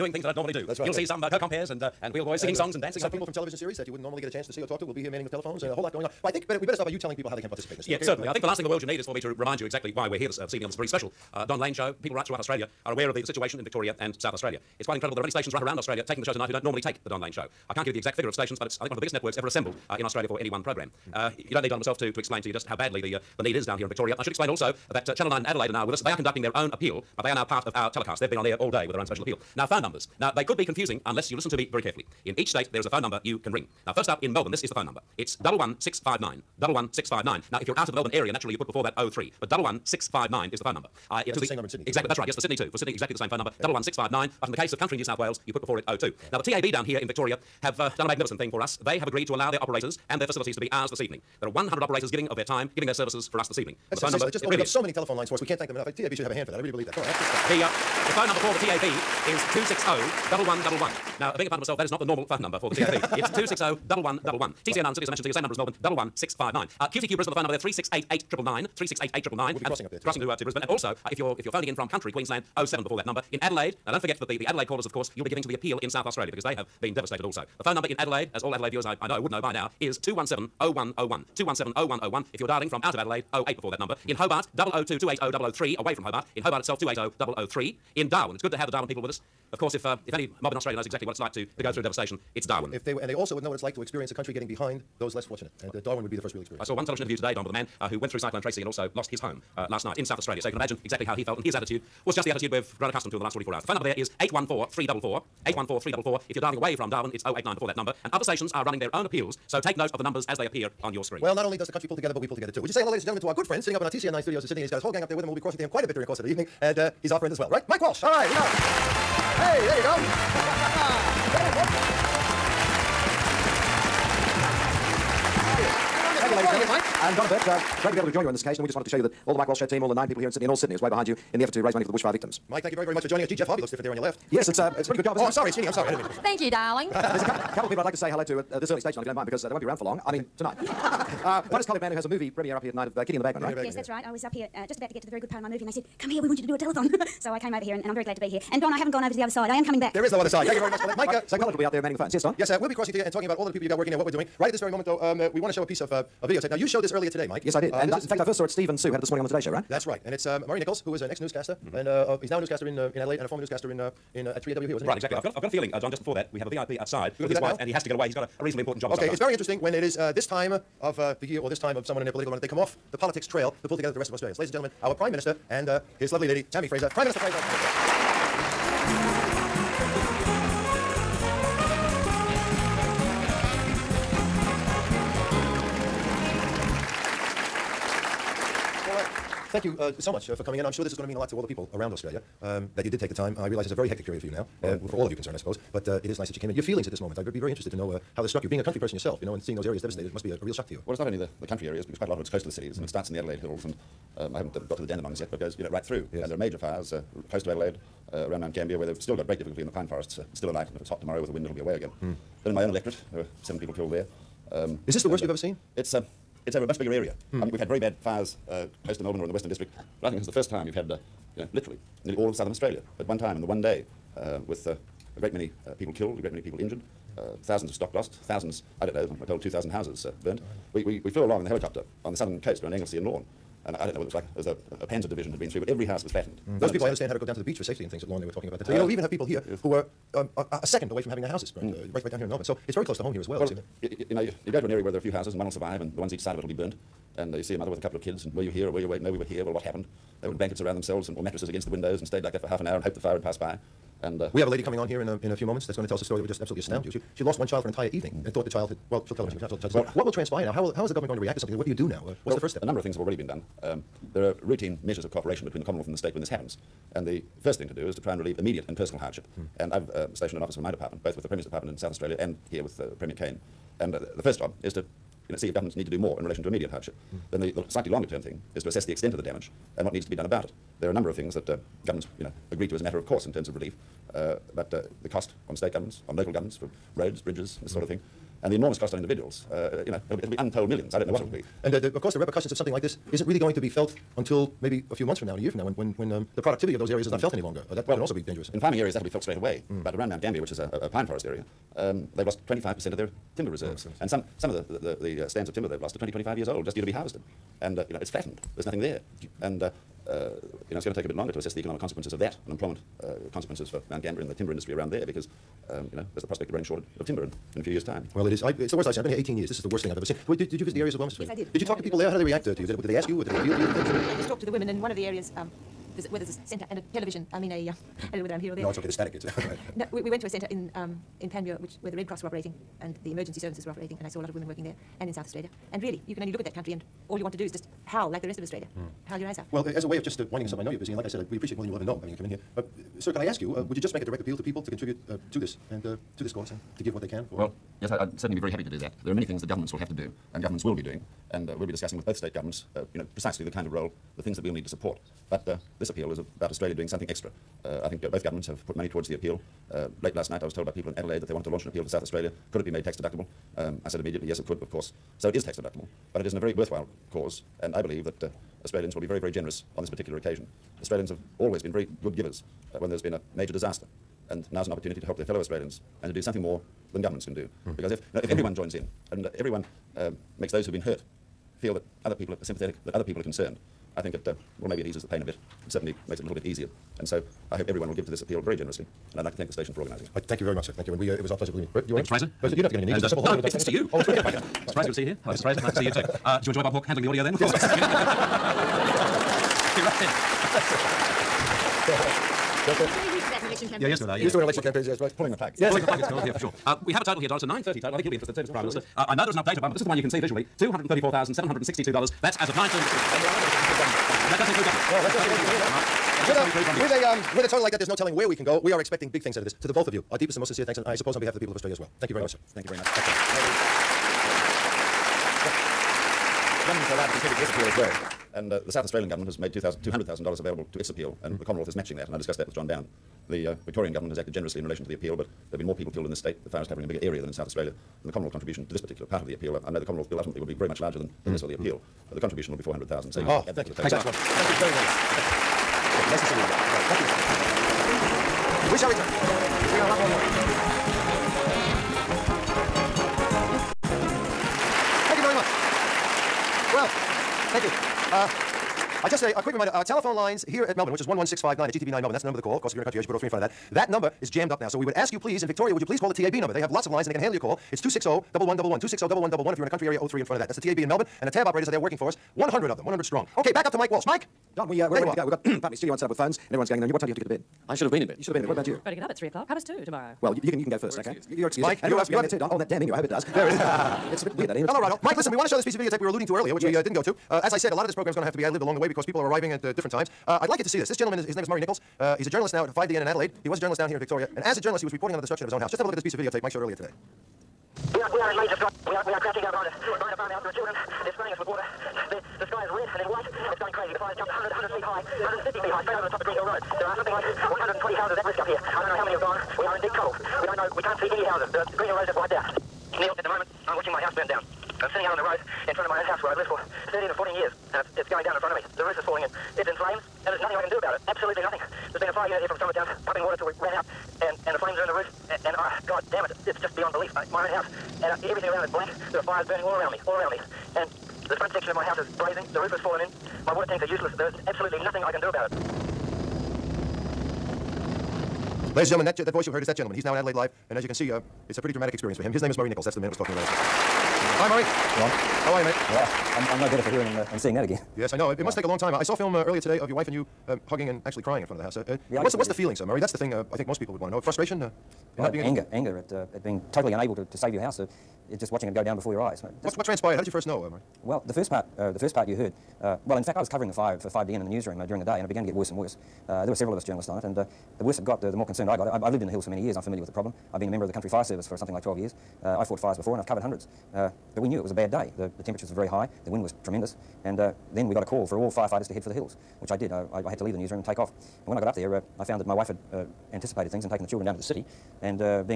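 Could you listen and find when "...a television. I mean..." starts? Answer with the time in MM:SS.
05:26.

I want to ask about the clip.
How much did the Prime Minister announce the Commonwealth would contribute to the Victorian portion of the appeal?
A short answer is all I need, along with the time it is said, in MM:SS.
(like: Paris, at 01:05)
400,000, at 07:22.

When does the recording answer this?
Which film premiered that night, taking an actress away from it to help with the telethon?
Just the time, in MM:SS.
02:23.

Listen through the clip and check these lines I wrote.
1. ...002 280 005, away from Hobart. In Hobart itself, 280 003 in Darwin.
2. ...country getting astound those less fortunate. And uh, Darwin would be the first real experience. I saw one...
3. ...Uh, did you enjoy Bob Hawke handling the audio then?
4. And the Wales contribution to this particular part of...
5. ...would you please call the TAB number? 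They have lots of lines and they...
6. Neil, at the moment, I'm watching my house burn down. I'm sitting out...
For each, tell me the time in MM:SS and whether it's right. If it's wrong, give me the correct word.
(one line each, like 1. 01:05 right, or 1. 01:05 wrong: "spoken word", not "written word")
1. 01:24 wrong: "003", not "005"
2. 01:34 wrong: "behind", not "astound"
3. 06:36 right
4. 07:18 wrong: "Commonwealth", not "Wales"
5. 07:45 right
6. 08:32 right.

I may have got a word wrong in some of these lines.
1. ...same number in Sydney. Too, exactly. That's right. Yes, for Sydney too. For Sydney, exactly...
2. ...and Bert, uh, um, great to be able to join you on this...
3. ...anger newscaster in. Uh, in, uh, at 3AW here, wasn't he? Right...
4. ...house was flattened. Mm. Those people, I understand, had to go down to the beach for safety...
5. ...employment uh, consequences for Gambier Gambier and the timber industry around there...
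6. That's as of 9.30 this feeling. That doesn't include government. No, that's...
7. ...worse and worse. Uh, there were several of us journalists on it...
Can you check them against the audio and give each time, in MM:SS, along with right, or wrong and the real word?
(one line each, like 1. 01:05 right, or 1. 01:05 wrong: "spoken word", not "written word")
1. 00:41 right
2. 02:07 right
3. 02:43 wrong: "former", not "anger"
4. 03:55 right
5. 05:12 wrong: "Mount", not "Gambier"
6. 06:52 wrong: "evening", not "feeling"
7. 09:25 right.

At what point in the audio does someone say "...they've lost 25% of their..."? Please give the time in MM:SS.
05:02.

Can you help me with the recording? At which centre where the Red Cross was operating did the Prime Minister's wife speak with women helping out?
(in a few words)
Panmure.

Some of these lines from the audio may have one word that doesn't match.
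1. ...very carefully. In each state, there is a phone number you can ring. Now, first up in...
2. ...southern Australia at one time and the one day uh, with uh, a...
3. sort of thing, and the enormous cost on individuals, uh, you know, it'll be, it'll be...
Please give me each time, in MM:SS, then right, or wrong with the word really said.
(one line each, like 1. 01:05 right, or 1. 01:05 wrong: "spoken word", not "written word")
1. 00:31 right
2. 03:42 right
3. 04:47 right.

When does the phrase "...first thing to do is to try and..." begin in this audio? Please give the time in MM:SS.
04:27.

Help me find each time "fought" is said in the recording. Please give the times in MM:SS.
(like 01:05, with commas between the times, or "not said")
09:32.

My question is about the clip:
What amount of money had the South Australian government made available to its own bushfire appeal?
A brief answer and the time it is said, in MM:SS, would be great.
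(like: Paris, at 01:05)
$200,000, at 07:09.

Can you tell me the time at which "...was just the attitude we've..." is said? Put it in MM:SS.
01:42.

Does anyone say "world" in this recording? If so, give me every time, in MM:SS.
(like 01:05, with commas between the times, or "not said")
00:08.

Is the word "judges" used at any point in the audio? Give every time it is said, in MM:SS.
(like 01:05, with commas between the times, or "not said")
04:19.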